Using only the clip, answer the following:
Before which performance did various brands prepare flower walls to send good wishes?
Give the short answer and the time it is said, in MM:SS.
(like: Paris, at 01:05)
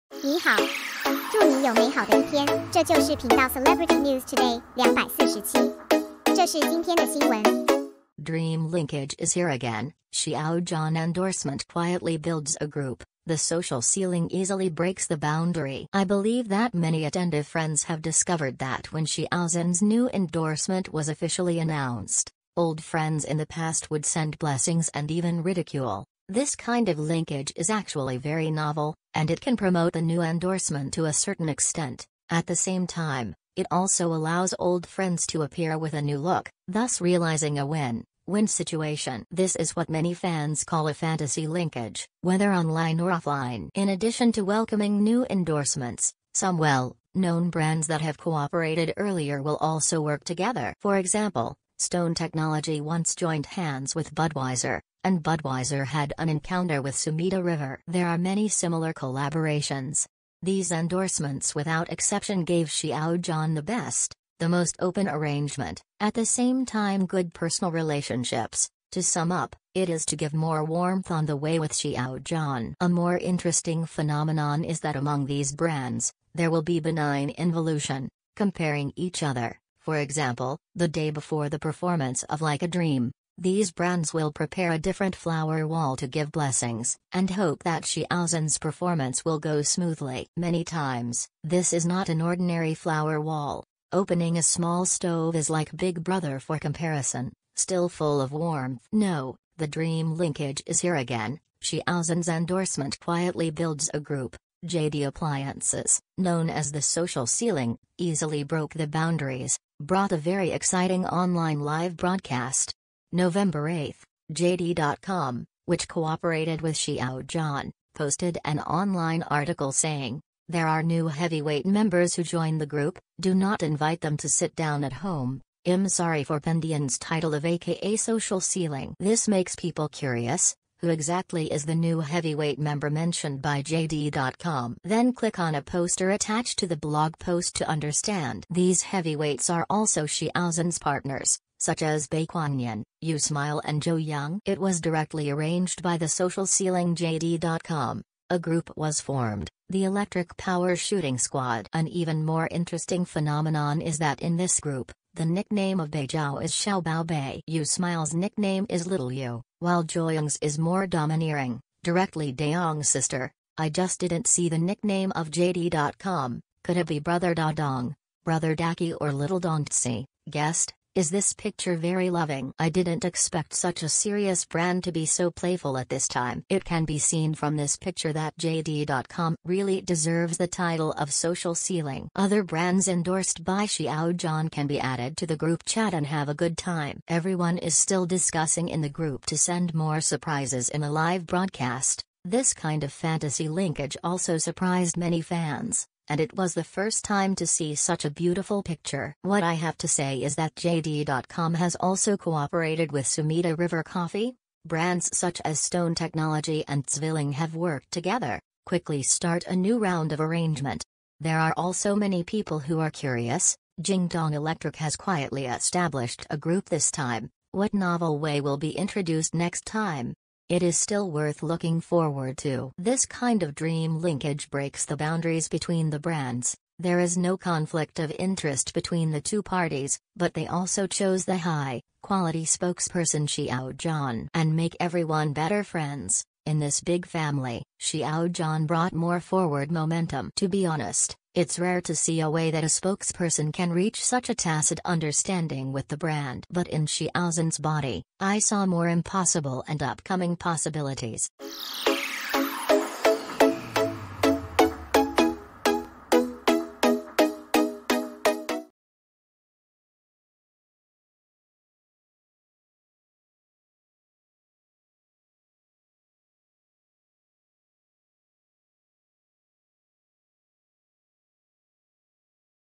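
Like a Dream, at 01:22.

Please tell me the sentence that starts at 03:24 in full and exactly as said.
Brands such as Stone Technology and Zwilling have worked together, quickly start a new round of arrangement.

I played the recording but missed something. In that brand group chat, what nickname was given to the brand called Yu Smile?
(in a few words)
Little Yu.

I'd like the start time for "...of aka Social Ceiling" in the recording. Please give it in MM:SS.
02:07.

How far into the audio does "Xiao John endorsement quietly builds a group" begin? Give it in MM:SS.
00:10.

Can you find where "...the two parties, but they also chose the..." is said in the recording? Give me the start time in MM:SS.
03:49.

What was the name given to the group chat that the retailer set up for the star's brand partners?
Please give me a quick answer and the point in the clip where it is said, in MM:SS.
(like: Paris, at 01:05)
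Electric Power Shooting Squad, at 02:29.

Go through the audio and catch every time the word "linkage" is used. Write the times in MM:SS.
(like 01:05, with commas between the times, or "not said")
00:08, 00:26, 00:41, 01:40, 03:13, 03:44.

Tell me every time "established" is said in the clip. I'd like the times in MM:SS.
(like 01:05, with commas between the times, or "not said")
03:35.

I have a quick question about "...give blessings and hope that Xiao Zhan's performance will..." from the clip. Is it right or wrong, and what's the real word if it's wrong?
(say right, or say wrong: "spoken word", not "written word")
right.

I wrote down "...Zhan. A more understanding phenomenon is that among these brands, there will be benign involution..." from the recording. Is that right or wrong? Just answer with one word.
wrong.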